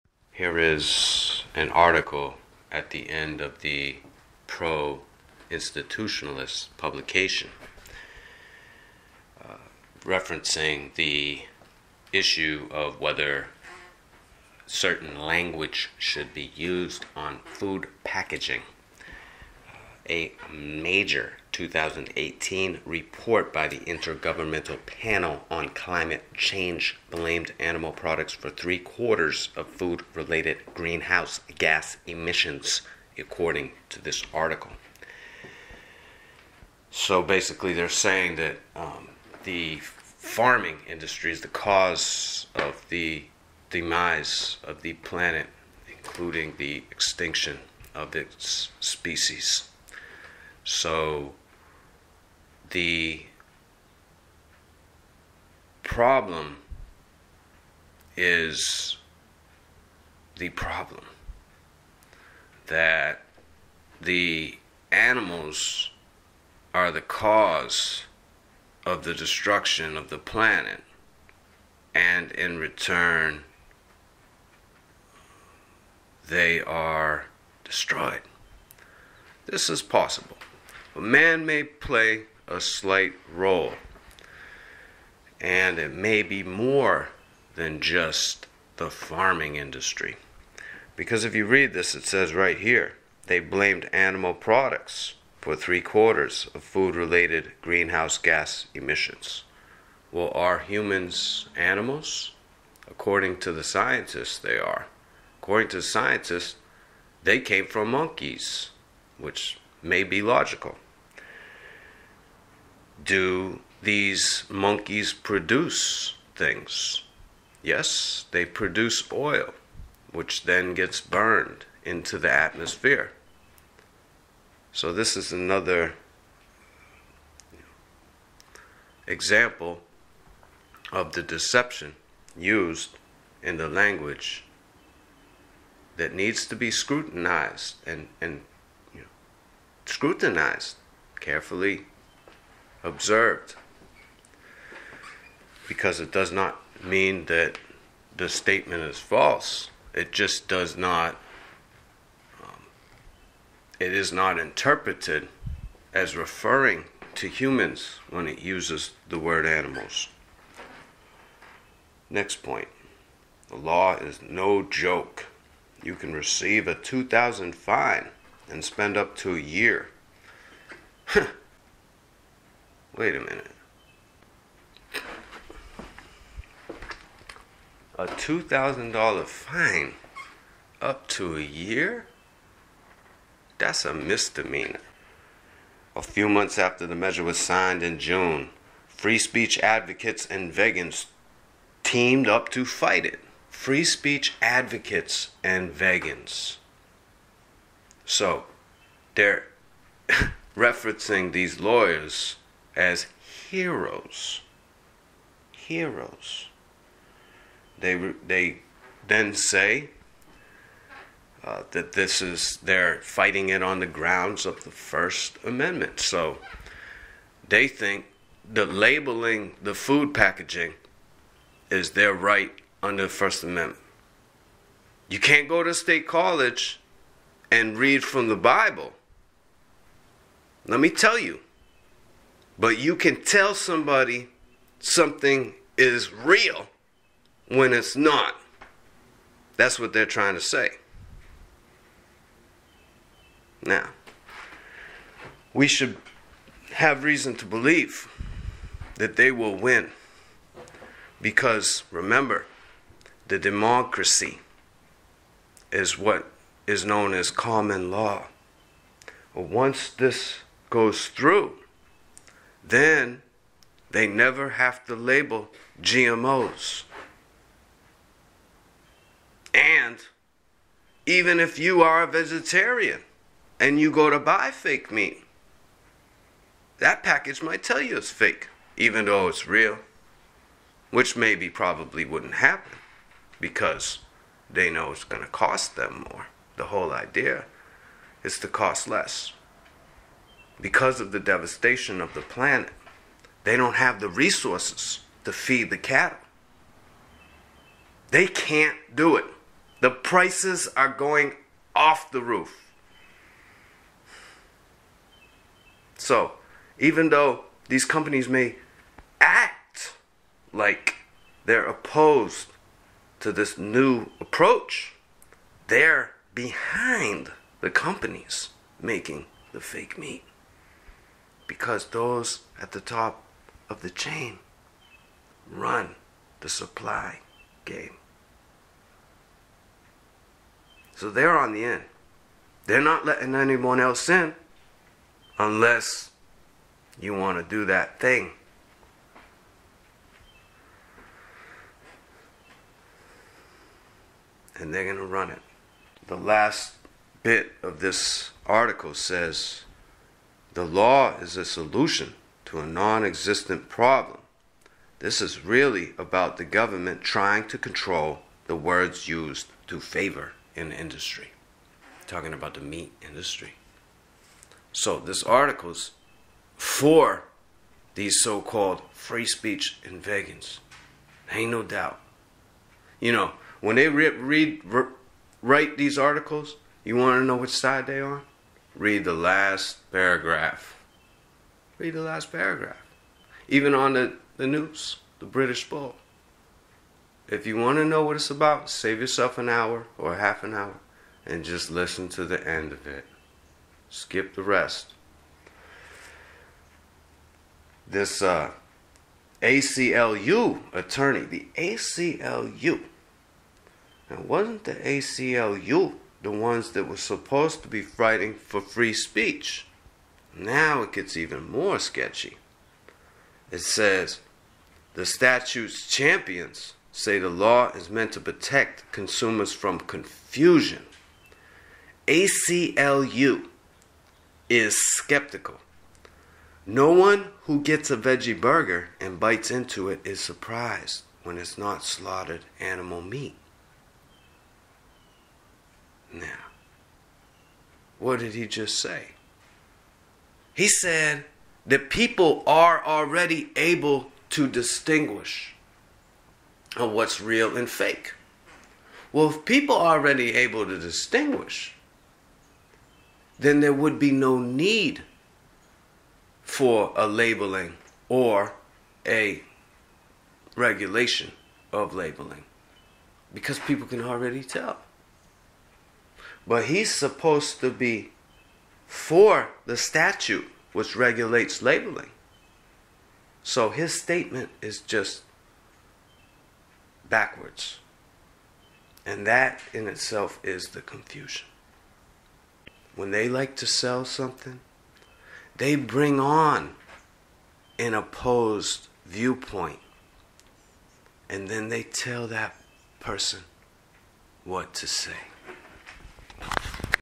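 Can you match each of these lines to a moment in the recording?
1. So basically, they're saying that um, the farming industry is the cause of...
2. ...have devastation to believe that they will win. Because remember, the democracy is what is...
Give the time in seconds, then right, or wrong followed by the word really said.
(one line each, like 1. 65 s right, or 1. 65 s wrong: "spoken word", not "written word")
1. 36 s right
2. 246 s wrong: "reason", not "devastation".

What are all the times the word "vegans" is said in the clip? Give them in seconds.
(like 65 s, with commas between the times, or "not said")
190 s, 195 s, 370 s.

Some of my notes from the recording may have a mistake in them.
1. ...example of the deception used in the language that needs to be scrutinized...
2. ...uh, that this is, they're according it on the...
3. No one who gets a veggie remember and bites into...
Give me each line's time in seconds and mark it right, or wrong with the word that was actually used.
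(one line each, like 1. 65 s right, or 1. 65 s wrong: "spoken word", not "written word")
1. 129 s right
2. 211 s wrong: "fighting", not "according"
3. 426 s wrong: "burger", not "remember".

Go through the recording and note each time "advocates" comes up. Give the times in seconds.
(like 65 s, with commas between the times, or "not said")
189 s, 194 s.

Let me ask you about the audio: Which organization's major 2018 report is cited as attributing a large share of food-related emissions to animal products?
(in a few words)
Intergovernmental Panel on Climate Change.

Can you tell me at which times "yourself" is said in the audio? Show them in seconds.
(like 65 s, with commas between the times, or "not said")
388 s.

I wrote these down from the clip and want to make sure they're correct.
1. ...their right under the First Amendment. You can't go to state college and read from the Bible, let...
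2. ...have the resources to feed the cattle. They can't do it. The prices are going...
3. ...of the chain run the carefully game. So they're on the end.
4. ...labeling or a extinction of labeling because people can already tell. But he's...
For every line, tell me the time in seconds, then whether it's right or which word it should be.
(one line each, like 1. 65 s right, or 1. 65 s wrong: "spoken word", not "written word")
1. 221 s right
2. 293 s right
3. 323 s wrong: "supply", not "carefully"
4. 457 s wrong: "regulation", not "extinction".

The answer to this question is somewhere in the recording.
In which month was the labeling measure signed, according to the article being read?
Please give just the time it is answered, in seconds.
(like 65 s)
187 s.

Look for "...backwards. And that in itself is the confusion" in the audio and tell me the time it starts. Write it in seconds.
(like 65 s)
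477 s.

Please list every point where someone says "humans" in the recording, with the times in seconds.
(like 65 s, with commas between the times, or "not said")
100 s, 157 s.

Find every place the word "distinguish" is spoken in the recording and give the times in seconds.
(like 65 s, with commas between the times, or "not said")
444 s, 450 s.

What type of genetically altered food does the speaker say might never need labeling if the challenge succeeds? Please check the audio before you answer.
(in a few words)
GMOs.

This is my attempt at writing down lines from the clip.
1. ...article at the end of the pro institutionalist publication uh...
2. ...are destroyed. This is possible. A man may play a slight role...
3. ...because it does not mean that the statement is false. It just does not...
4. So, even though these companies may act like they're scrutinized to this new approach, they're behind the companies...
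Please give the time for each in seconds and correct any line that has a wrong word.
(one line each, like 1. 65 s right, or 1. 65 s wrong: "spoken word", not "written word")
1. 1 s right
2. 76 s right
3. 145 s right
4. 305 s wrong: "opposed", not "scrutinized".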